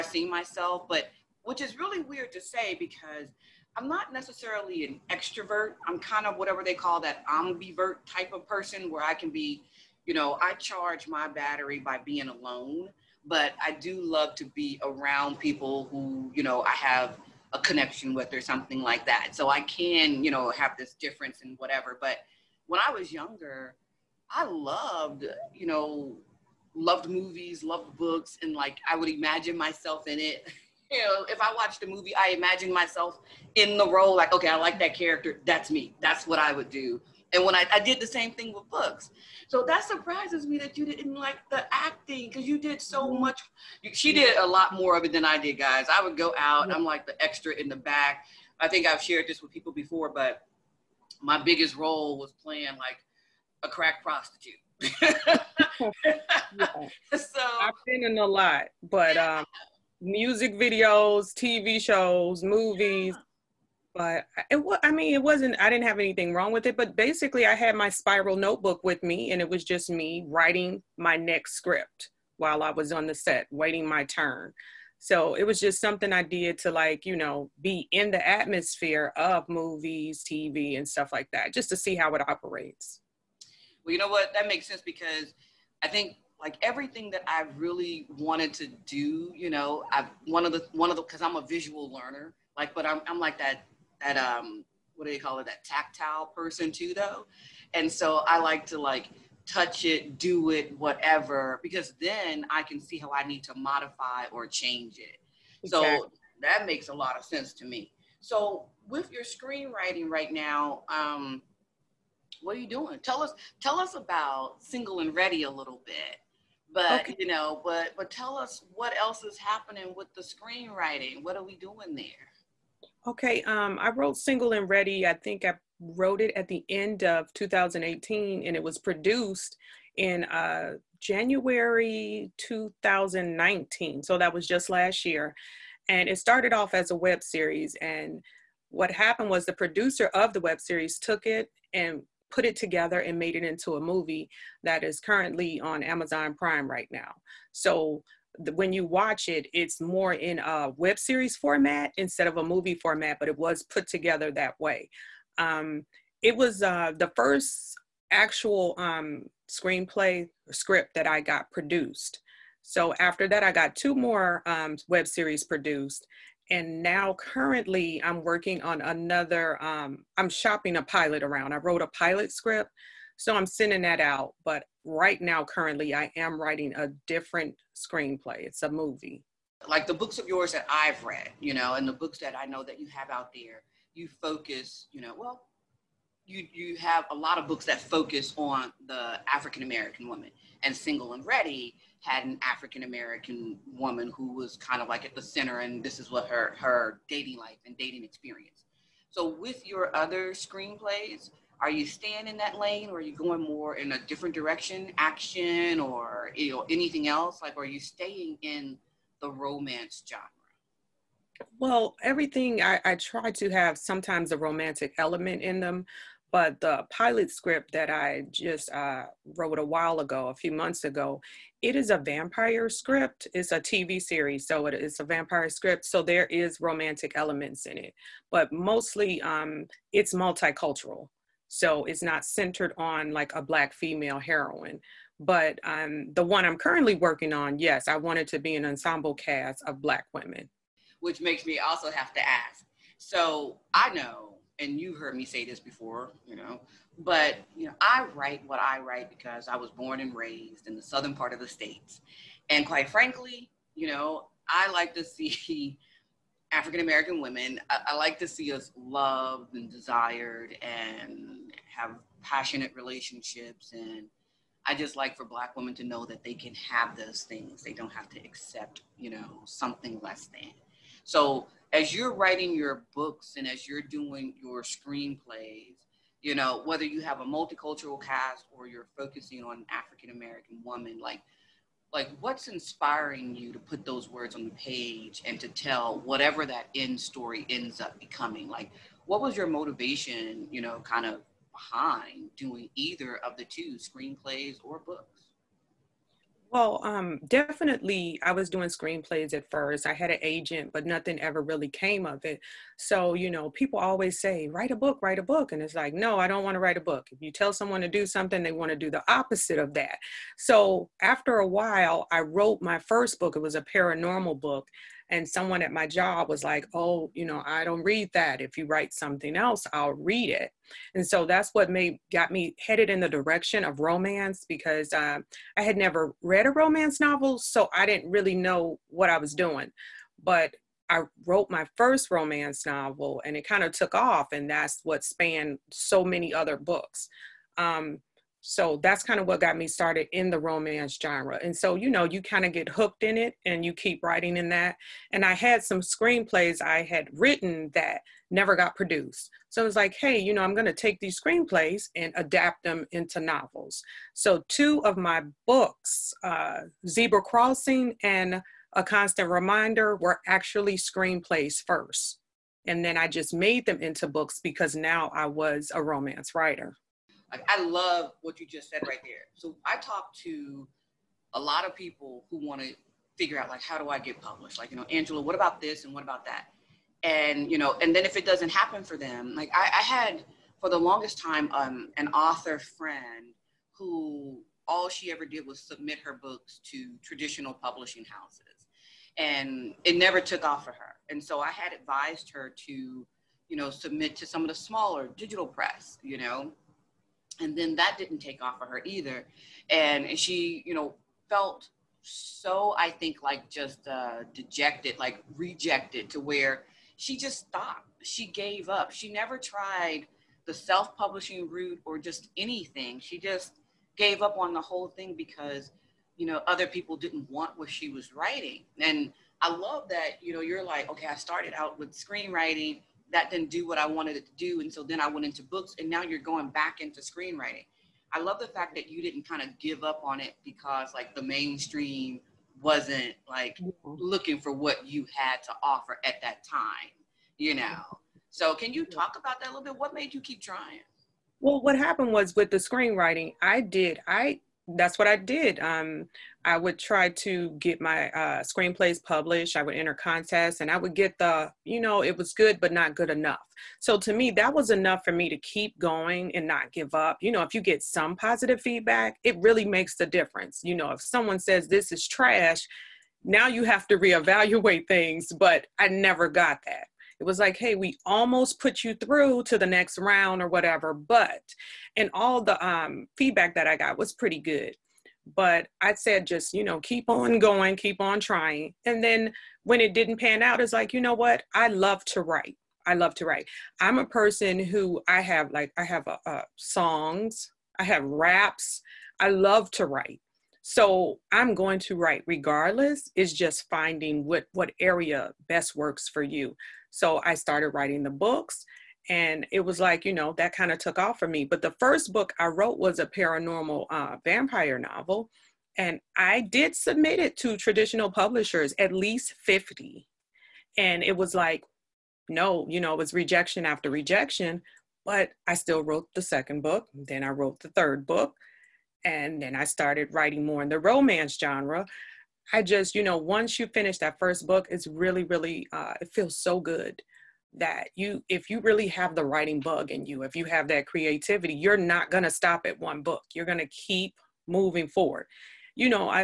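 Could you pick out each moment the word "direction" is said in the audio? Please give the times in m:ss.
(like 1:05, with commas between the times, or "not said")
3:24, 5:23.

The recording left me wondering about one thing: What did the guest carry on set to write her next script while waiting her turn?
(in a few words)
spiral notebook.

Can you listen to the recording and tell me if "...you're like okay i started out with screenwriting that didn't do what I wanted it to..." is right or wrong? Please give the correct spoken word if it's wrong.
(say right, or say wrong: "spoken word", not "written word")
right.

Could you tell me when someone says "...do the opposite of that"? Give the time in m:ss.
5:08.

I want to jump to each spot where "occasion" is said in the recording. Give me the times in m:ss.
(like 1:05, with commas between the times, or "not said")
not said.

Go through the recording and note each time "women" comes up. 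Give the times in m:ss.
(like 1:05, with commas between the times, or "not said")
4:00, 4:17, 4:25.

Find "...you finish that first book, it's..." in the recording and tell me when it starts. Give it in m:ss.
8:43.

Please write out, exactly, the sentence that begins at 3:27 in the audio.
Like, are you staying in the romance genre?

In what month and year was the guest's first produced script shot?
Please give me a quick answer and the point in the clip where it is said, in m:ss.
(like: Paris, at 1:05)
January 2019, at 2:10.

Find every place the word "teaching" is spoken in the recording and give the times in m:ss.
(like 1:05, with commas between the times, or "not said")
not said.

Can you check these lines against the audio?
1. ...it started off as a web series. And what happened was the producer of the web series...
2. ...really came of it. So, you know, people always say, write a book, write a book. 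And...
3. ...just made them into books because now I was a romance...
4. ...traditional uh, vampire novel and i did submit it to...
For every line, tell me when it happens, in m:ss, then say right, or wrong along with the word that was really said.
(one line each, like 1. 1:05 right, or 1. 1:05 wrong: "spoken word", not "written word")
1. 2:16 right
2. 5:01 right
3. 6:03 right
4. 8:23 wrong: "paranormal", not "traditional".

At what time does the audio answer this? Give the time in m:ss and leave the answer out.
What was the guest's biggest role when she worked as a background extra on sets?
0:53.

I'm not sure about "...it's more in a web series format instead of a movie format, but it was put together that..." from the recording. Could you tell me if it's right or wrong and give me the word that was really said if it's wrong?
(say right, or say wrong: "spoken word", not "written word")
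right.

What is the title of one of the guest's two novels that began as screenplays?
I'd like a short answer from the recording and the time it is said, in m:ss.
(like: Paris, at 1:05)
Zebra Crossing, at 5:56.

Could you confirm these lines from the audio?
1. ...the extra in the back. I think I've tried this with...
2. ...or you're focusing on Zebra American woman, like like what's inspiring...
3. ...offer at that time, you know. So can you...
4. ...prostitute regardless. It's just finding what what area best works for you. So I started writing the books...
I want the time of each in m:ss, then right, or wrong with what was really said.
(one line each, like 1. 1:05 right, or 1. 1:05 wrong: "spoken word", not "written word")
1. 0:47 wrong: "shared", not "tried"
2. 4:38 wrong: "African", not "Zebra"
3. 7:15 right
4. 8:11 wrong: "write", not "prostitute".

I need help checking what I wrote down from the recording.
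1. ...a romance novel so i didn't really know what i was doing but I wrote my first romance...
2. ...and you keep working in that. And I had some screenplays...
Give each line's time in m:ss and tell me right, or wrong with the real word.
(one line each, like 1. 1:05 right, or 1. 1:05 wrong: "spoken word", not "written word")
1. 5:26 right
2. 5:43 wrong: "writing", not "working".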